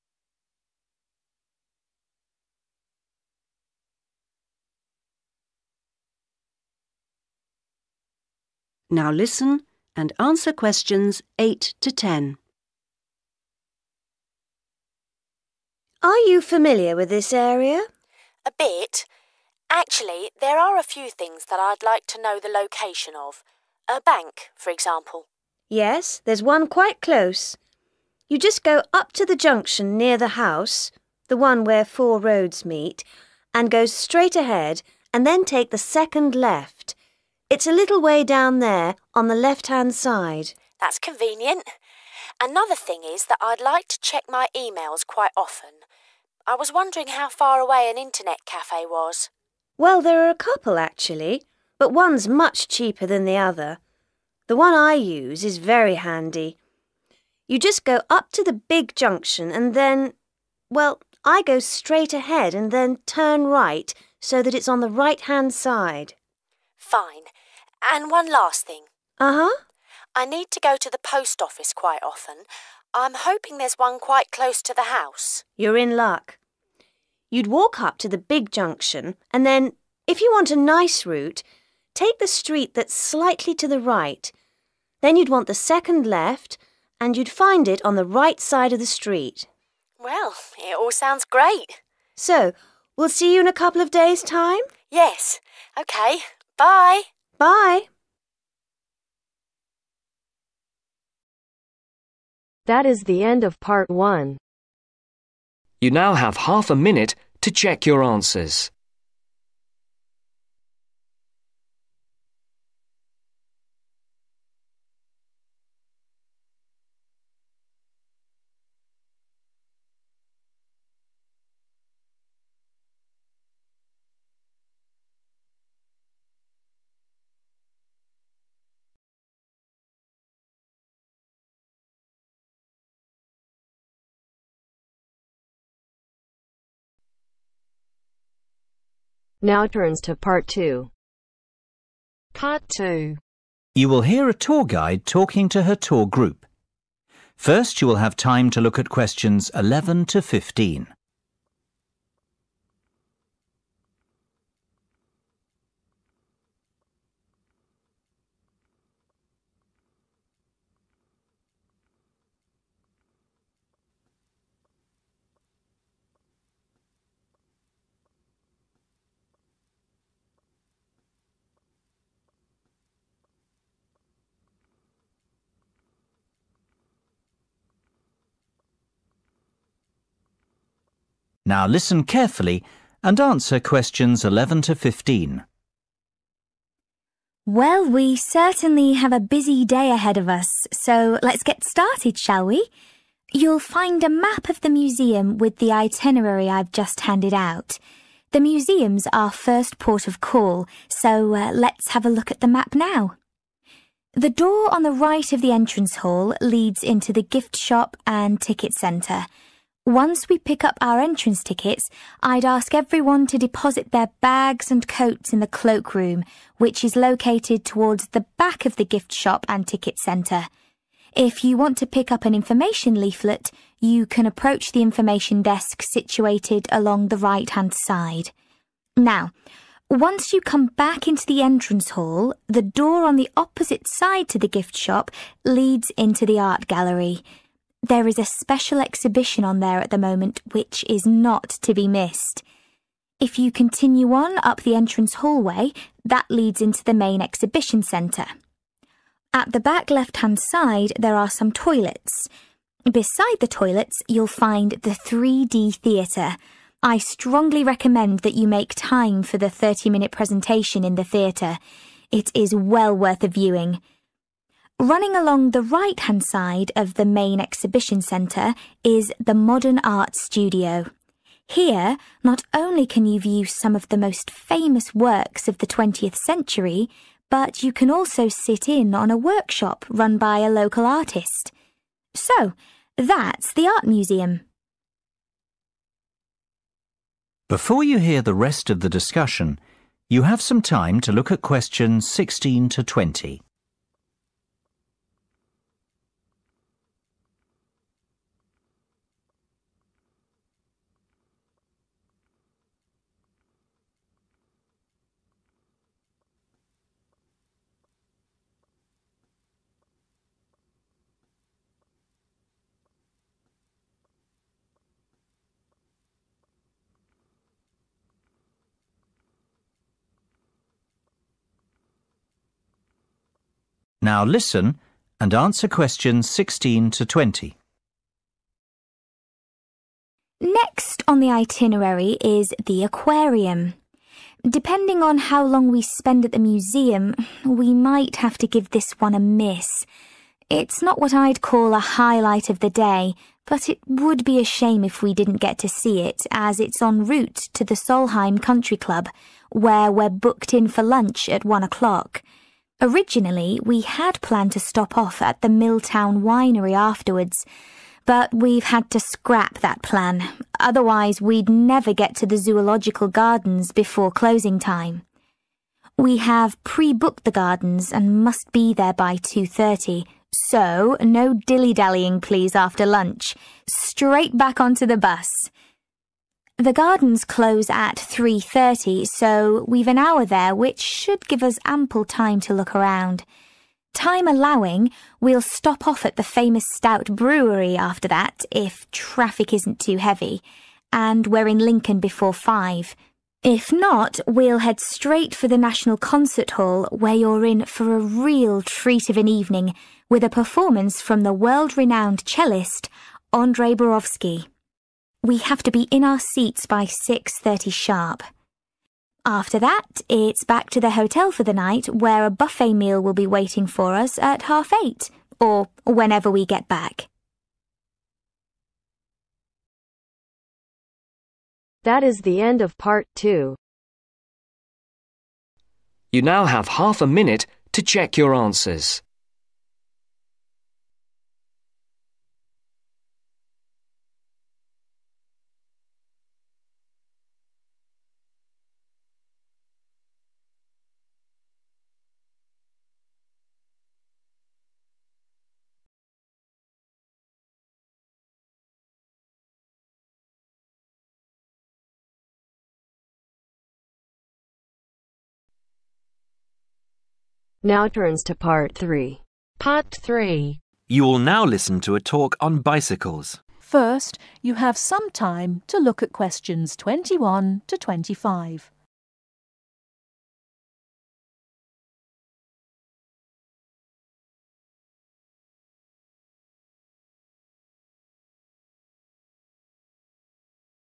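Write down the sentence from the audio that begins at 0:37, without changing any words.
It's a little way down there on the left hand side.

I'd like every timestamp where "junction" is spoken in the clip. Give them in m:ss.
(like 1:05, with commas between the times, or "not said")
0:29, 0:58, 1:18.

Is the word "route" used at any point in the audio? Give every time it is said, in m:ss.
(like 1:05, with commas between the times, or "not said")
1:21, 5:47.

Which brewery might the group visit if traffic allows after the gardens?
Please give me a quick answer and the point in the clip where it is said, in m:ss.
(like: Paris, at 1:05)
Stout Brewery, at 6:26.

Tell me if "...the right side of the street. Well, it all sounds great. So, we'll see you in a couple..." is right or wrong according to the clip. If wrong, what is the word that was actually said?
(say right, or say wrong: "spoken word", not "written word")
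right.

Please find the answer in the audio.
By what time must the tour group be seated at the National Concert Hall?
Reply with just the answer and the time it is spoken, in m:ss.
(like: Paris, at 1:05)
6.30, at 6:46.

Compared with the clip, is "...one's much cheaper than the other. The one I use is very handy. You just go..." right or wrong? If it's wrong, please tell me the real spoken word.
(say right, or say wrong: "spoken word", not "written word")
right.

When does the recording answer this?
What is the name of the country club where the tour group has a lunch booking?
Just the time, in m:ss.
5:47.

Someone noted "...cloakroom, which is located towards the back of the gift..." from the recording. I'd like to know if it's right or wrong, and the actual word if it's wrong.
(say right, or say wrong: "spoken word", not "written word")
right.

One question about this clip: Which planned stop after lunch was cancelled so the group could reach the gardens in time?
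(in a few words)
Milltown Winery.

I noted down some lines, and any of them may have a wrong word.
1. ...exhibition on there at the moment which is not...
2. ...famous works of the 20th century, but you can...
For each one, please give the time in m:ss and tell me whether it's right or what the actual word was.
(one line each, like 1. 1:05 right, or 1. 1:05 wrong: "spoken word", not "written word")
1. 3:58 right
2. 4:34 right.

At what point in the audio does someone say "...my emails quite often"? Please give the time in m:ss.
0:44.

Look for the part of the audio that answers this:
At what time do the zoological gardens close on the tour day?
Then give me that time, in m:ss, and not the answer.
6:17.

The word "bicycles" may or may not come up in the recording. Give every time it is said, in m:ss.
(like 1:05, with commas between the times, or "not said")
7:42.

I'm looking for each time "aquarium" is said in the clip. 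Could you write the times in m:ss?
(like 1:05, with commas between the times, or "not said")
5:32.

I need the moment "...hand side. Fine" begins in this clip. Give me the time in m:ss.
1:05.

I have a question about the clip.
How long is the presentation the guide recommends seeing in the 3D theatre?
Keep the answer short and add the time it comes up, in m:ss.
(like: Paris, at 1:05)
30 minutes, at 4:19.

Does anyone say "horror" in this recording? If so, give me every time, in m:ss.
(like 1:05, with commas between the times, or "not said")
not said.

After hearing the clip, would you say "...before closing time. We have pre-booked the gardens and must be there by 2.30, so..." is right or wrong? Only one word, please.
right.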